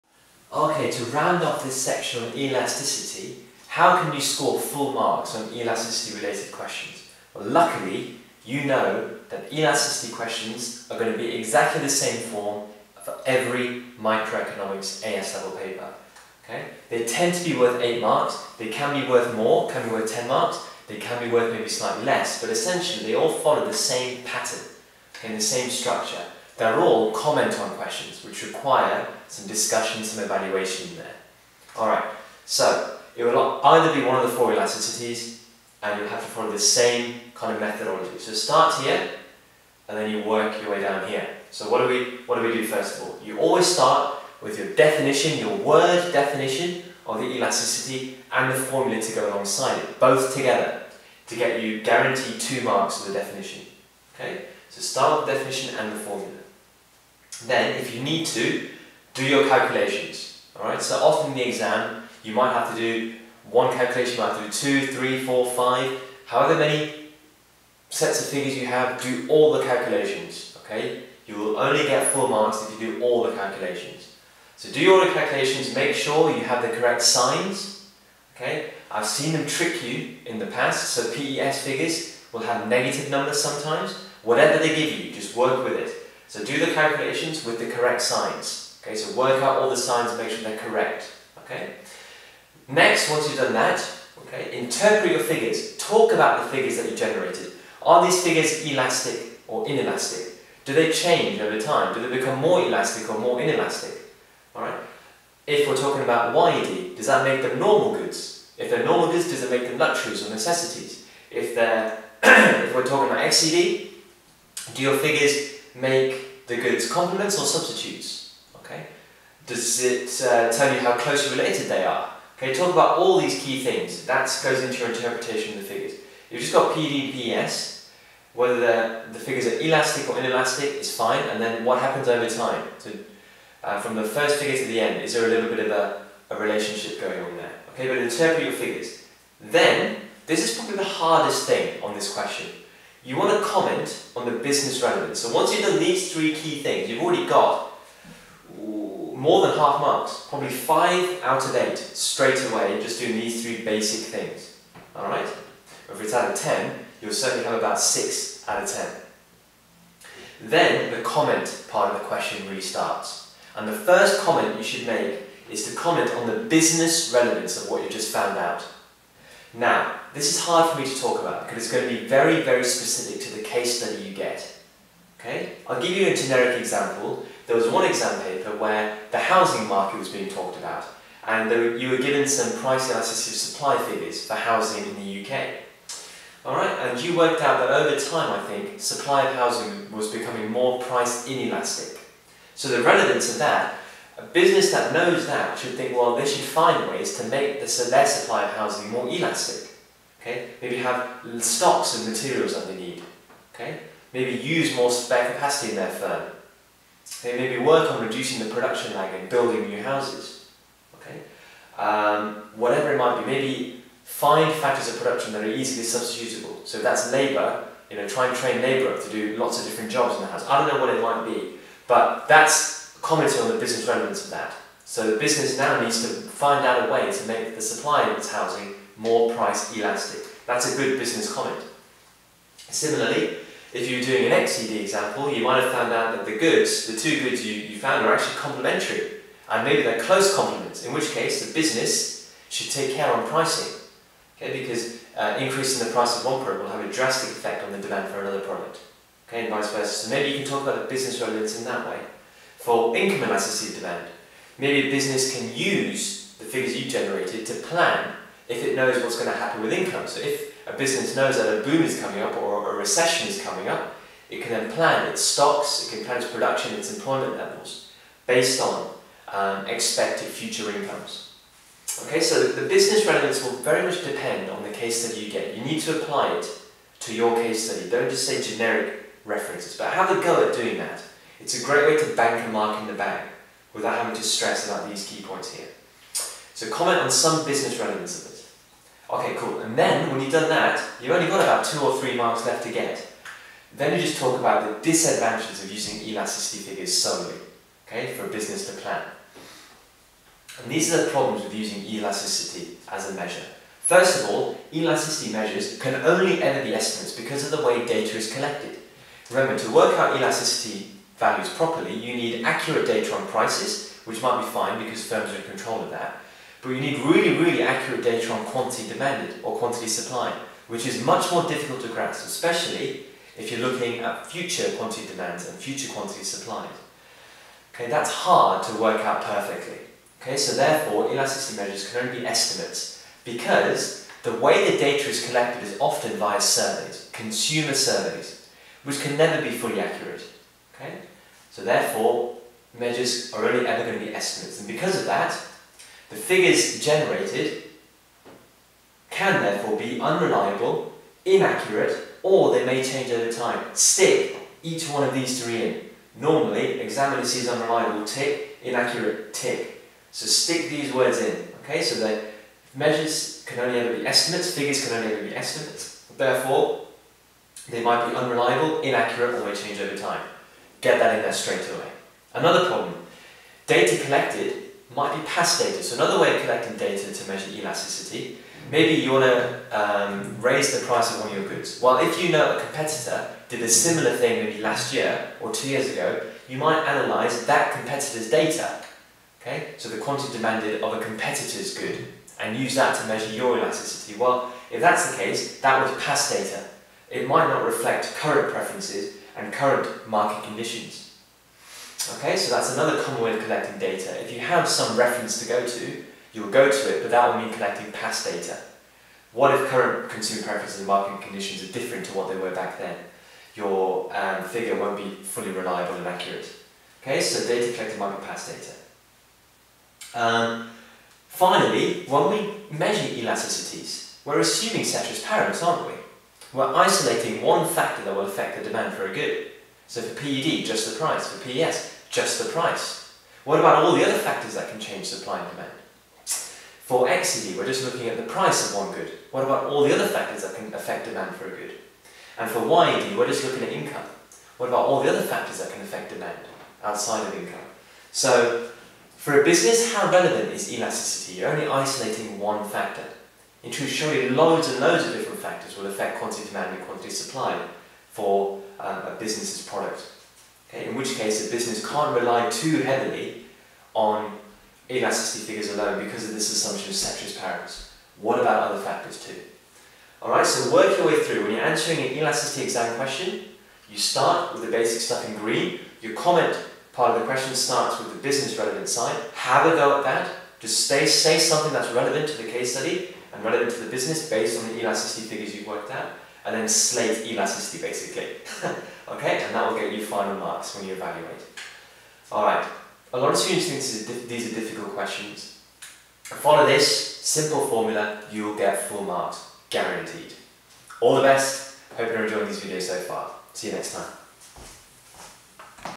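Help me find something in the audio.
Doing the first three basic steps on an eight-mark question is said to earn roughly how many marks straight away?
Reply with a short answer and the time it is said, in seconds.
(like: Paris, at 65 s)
5 out of 8, at 150 s.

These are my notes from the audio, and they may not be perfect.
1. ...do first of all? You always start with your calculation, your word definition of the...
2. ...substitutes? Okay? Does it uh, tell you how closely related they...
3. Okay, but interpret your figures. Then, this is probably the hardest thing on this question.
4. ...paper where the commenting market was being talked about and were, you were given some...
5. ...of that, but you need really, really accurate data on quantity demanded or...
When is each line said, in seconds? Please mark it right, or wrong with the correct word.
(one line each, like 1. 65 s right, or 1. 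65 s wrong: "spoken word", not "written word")
1. 42 s wrong: "definition", not "calculation"
2. 117 s right
3. 137 s right
4. 178 s wrong: "housing", not "commenting"
5. 315 s right.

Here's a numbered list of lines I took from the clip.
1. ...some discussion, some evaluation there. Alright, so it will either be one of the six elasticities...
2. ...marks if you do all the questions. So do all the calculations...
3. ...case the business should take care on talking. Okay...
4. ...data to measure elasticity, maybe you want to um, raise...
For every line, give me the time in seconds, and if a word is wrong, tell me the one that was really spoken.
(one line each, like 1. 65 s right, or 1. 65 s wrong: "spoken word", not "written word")
1. 29 s wrong: "four", not "six"
2. 72 s wrong: "calculations", not "questions"
3. 241 s wrong: "pricing", not "talking"
4. 376 s right.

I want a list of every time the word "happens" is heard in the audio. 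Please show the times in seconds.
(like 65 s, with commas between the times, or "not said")
131 s, 259 s.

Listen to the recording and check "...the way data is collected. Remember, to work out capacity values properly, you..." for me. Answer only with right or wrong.
wrong.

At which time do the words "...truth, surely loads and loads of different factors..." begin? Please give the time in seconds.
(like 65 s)
453 s.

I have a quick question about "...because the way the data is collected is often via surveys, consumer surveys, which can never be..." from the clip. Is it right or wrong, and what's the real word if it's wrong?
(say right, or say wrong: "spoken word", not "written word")
right.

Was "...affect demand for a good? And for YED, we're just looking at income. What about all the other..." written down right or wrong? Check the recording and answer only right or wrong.
right.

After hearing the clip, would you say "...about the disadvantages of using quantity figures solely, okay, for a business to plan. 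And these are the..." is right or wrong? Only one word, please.
wrong.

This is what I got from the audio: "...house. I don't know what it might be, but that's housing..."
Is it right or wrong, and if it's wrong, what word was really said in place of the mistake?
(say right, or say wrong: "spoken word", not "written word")
wrong: "commenting", not "housing".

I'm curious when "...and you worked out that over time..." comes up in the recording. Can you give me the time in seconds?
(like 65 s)
186 s.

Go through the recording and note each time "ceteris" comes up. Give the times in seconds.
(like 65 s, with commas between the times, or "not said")
424 s, 466 s.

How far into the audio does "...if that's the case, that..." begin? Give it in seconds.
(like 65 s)
394 s.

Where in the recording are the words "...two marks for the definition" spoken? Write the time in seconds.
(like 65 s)
52 s.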